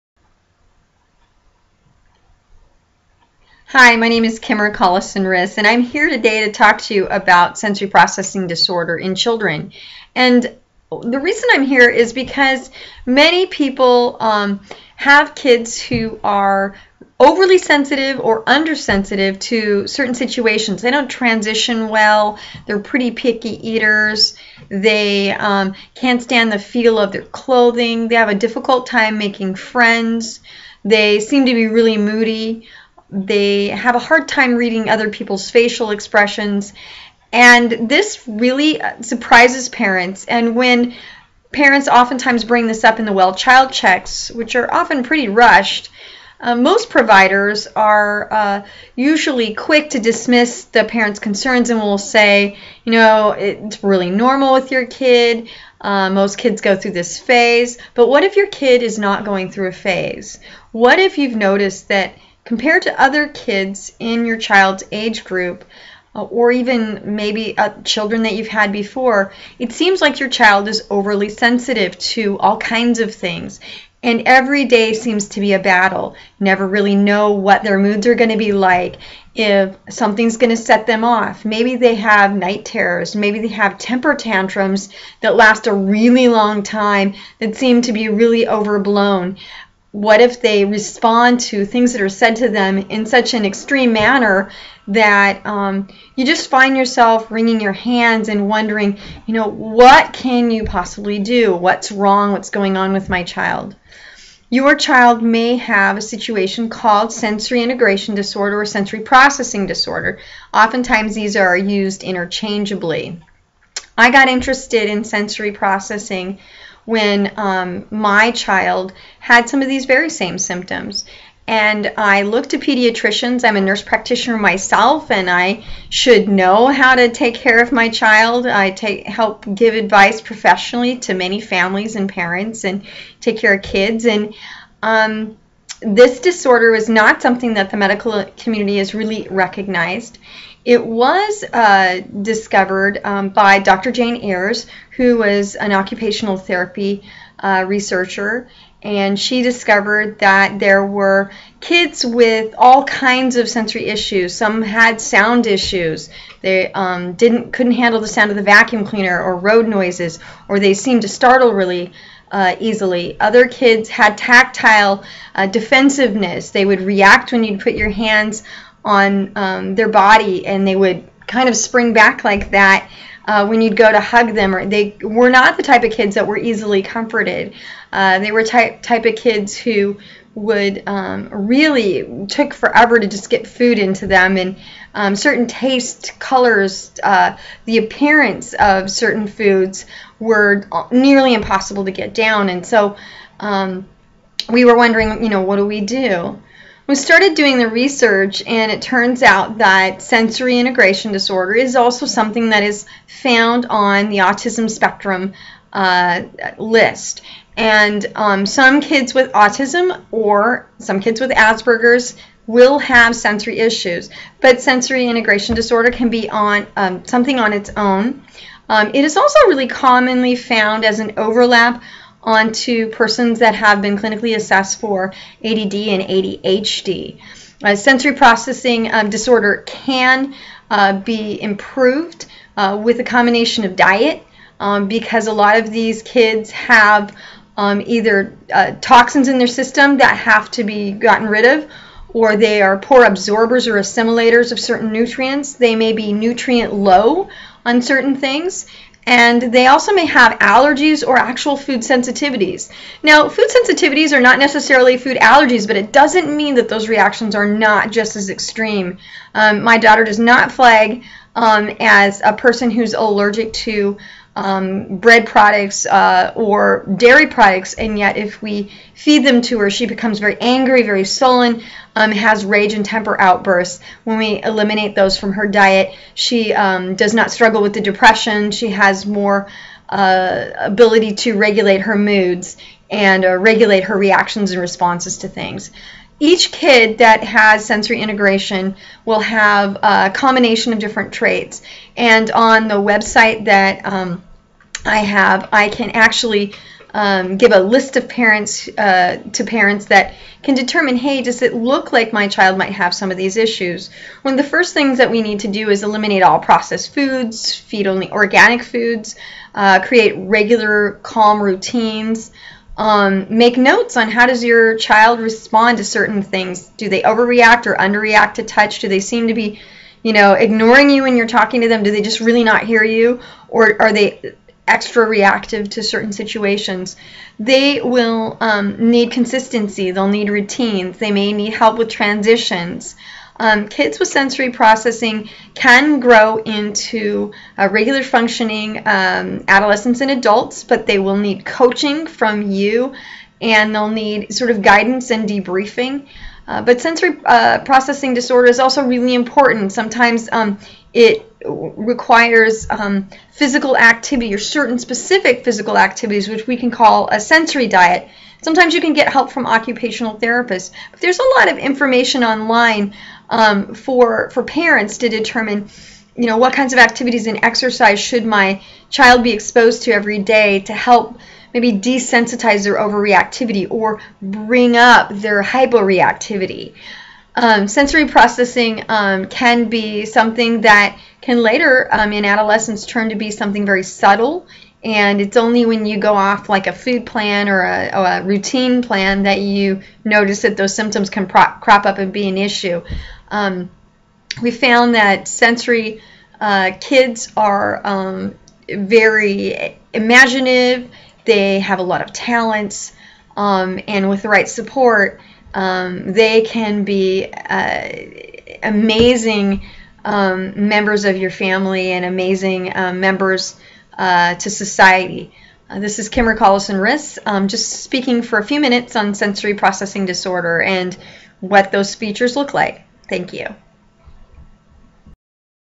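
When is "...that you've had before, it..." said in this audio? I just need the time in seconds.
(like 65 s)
68 s.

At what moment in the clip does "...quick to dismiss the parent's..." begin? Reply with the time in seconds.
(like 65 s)
49 s.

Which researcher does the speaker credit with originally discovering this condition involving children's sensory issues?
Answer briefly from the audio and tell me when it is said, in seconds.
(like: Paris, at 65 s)
Dr. Jane Ayres, at 143 s.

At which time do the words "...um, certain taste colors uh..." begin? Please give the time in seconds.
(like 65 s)
184 s.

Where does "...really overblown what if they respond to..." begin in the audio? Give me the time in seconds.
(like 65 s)
88 s.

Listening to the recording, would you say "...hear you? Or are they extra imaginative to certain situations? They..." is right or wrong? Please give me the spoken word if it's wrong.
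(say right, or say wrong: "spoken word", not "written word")
wrong: "reactive", not "imaginative".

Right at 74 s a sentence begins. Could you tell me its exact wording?
And every day seems to be a battle.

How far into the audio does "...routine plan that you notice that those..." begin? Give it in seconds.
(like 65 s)
388 s.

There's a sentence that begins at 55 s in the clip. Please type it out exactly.
Uh, most kids go through this phase.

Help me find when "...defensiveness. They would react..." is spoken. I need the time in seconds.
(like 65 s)
165 s.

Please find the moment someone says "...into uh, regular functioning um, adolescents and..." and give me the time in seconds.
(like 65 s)
336 s.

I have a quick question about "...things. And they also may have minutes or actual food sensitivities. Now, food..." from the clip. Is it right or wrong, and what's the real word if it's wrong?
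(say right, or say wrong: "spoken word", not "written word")
wrong: "allergies", not "minutes".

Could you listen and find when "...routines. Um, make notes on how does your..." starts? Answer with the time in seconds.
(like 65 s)
311 s.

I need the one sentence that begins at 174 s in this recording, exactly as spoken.
Or they were not the type of kids that were easily comforted.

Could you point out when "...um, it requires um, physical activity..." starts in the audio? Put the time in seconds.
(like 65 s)
350 s.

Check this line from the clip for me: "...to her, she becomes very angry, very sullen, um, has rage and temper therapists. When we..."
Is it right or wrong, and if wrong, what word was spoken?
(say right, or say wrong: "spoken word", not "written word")
wrong: "outbursts", not "therapists".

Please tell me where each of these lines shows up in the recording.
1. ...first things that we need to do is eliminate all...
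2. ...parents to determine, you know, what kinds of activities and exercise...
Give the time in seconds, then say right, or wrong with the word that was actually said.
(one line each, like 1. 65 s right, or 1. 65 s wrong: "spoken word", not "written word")
1. 304 s right
2. 364 s right.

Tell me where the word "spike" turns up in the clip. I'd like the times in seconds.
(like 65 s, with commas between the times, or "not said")
not said.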